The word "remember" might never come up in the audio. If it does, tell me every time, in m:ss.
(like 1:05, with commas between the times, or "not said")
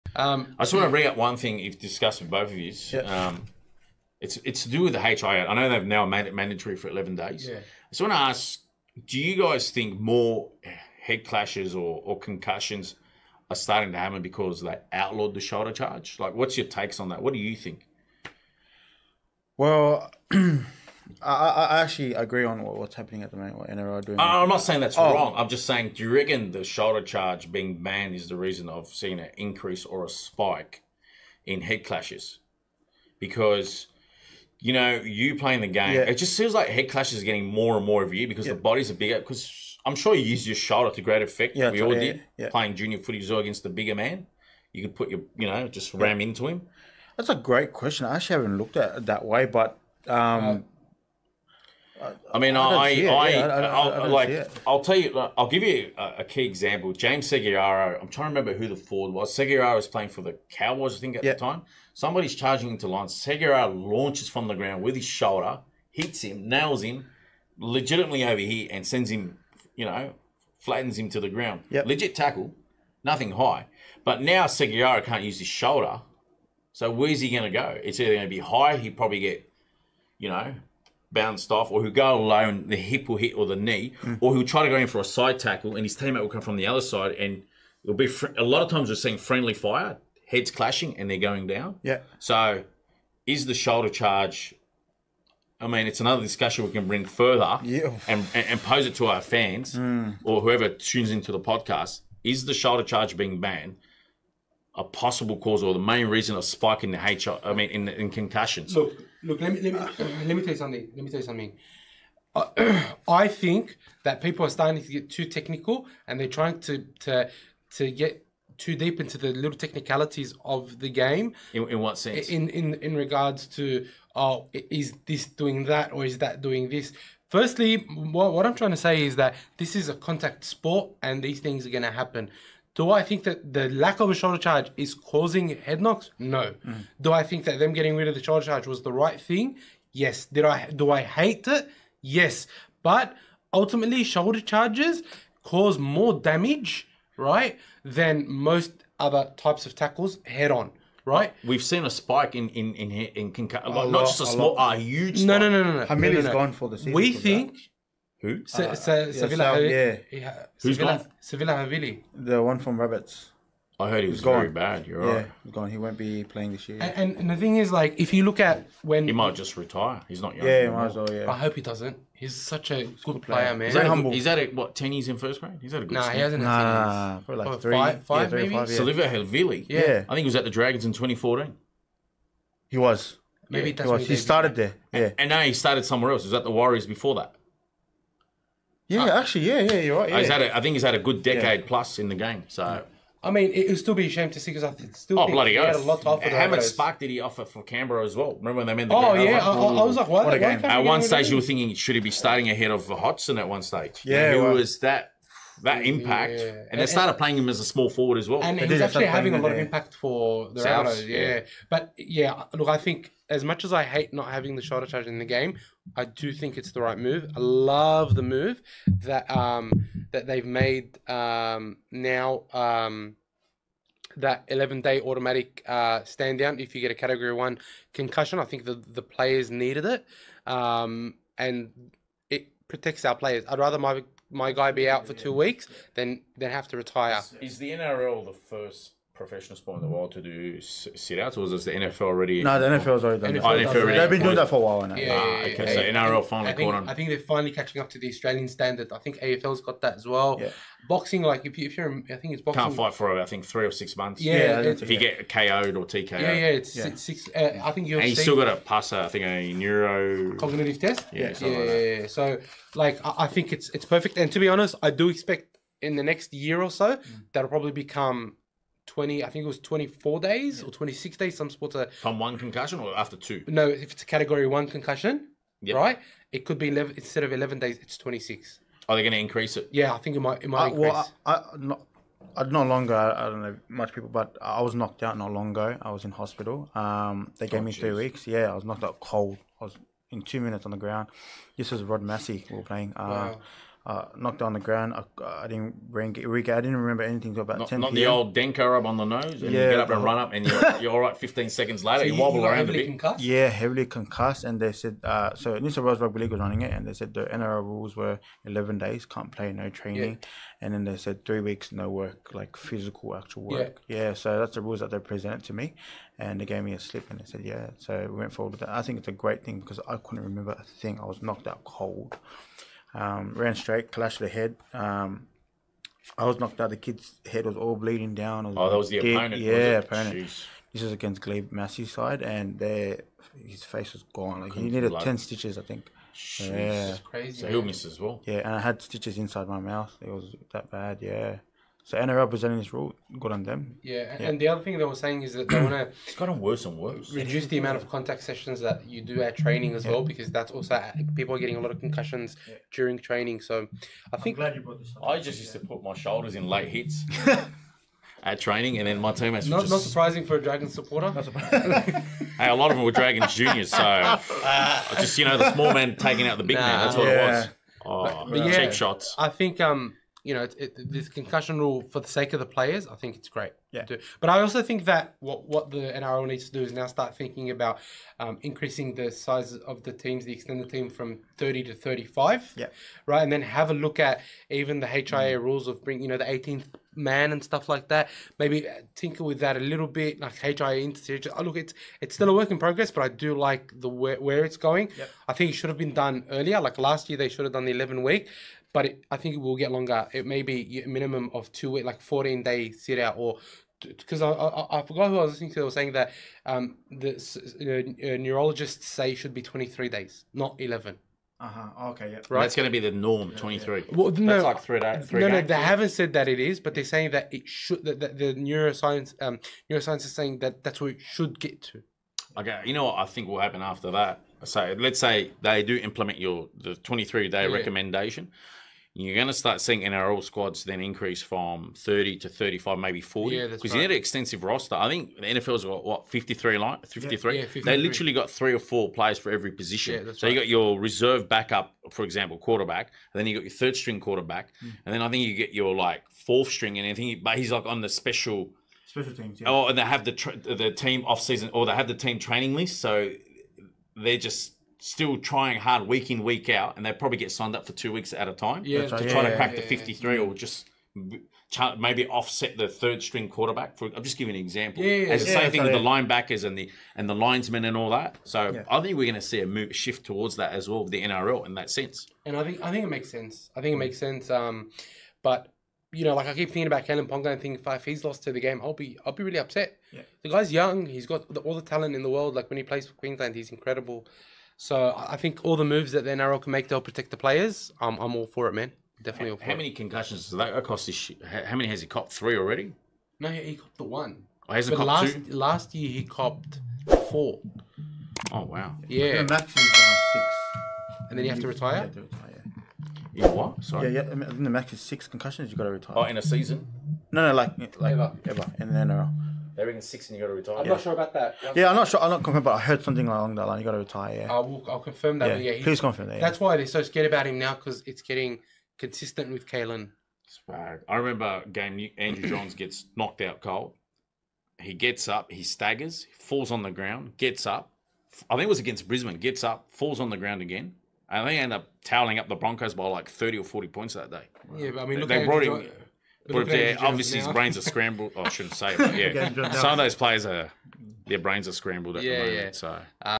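0:58, 3:18, 4:56, 5:20, 8:40.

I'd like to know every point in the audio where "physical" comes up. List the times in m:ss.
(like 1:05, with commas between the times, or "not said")
5:12.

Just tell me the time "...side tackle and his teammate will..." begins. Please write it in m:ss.
1:25.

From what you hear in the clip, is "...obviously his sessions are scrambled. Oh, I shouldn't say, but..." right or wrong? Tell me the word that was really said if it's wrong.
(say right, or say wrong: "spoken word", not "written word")
wrong: "brains", not "sessions".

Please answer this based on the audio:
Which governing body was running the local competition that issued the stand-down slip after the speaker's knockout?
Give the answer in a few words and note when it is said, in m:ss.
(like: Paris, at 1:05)
New South Wales Rugby League, at 5:05.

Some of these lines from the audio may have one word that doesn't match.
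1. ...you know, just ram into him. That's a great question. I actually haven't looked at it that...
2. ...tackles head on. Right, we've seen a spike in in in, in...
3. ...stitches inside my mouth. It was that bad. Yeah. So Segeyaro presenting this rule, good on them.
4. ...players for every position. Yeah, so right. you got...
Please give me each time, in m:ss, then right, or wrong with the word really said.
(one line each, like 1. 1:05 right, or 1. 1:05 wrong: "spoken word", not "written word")
1. 0:45 right
2. 2:29 right
3. 5:38 wrong: "NRL", not "Segeyaro"
4. 7:18 right.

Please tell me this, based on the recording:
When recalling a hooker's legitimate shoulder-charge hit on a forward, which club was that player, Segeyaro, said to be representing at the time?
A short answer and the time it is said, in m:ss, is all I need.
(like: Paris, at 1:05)
Cowboys, at 1:00.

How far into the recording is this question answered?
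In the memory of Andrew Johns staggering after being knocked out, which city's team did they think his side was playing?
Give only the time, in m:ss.
8:48.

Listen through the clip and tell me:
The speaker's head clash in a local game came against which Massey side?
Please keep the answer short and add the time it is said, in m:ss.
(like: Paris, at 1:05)
Glebe, at 5:31.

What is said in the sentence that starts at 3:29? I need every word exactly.
of impact for the Rabbitohs, yeah.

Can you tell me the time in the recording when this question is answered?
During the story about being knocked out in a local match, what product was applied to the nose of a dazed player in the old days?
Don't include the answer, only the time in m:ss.
4:58.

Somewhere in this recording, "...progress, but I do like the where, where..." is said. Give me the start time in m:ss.
6:32.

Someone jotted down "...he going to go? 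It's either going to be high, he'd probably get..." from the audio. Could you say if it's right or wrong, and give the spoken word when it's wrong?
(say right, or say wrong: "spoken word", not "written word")
right.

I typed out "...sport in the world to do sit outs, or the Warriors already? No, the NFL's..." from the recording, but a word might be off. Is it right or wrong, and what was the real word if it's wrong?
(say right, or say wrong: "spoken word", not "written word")
wrong: "NFL", not "Warriors".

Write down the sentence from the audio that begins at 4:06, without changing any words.
I think they're finally catching up to the Australian standard.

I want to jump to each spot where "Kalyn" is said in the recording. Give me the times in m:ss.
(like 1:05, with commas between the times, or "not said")
7:56, 8:39.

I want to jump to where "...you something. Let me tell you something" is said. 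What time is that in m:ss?
1:50.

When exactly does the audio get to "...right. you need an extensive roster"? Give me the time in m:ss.
7:13.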